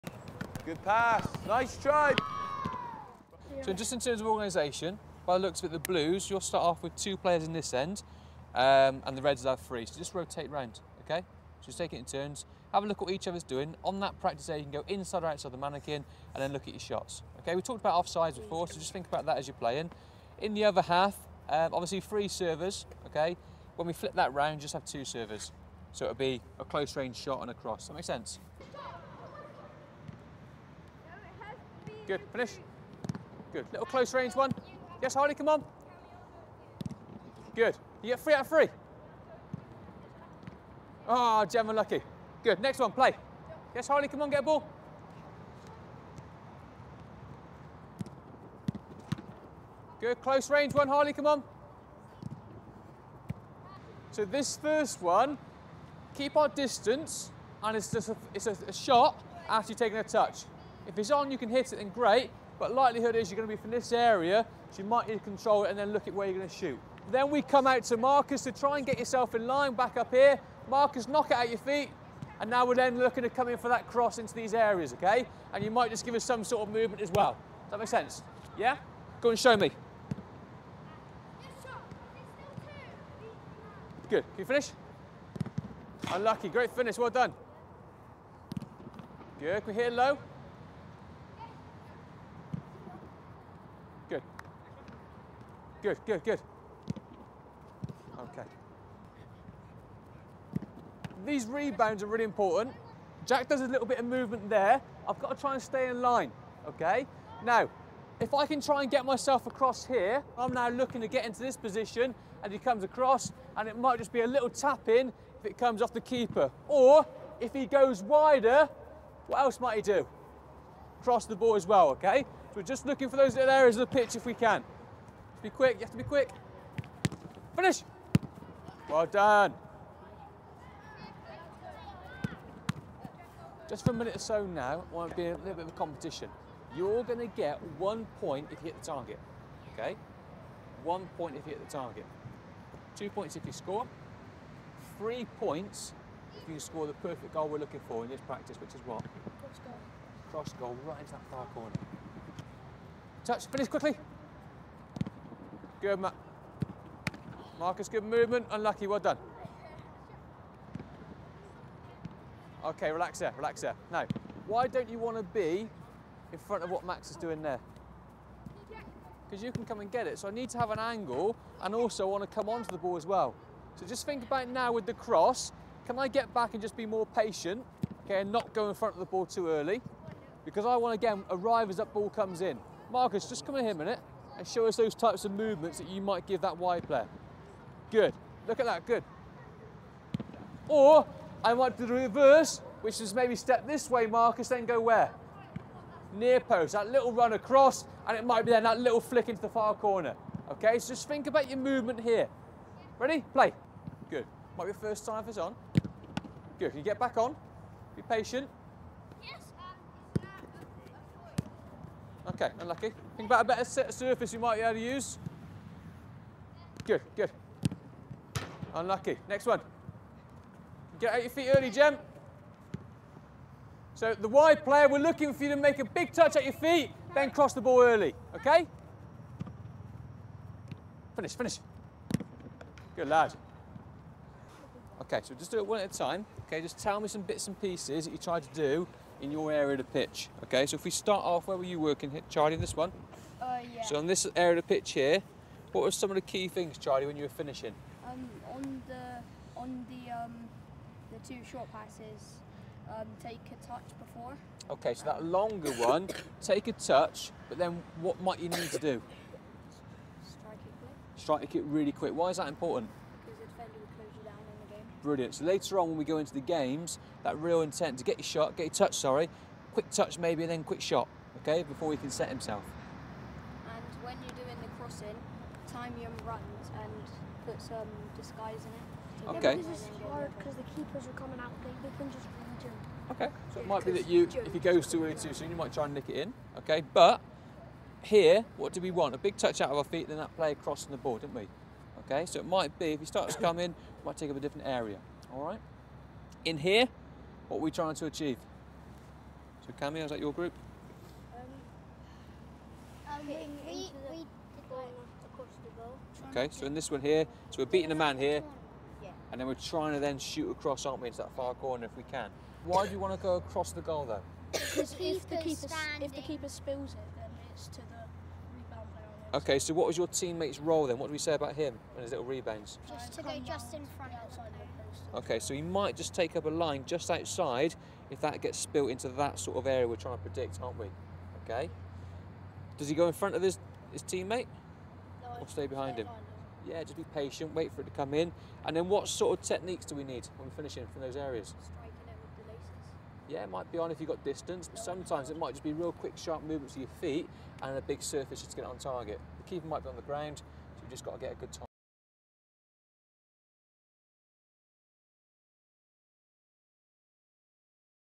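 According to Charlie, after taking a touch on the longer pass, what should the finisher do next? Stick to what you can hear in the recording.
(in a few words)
Strike it quick.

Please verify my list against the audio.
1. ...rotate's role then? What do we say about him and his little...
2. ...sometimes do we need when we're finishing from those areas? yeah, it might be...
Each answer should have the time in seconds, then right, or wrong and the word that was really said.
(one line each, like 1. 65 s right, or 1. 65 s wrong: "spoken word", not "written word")
1. 320 s wrong: "teammate", not "rotate"
2. 339 s wrong: "techniques", not "sometimes".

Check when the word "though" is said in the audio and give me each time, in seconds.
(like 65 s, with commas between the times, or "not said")
314 s.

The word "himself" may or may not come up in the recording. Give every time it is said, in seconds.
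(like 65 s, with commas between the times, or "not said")
272 s.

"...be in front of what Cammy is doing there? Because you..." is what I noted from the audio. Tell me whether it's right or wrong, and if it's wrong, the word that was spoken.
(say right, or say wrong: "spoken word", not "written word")
wrong: "Max", not "Cammy".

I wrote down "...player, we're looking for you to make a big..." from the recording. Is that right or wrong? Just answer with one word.
right.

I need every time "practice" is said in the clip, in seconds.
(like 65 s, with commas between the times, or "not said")
14 s, 148 s.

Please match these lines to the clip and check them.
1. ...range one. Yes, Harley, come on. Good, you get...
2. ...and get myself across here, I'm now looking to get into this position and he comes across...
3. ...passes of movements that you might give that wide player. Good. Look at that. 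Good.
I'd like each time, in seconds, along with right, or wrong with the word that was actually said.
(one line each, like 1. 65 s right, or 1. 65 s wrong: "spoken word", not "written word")
1. 34 s right
2. 108 s right
3. 184 s wrong: "types", not "passes".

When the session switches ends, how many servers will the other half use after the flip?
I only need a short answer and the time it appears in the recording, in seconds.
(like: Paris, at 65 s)
2, at 24 s.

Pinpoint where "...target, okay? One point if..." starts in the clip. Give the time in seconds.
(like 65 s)
138 s.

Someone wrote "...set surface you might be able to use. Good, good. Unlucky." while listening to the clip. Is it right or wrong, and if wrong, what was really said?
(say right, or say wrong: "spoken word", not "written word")
right.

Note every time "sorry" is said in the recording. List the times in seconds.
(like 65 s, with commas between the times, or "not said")
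268 s.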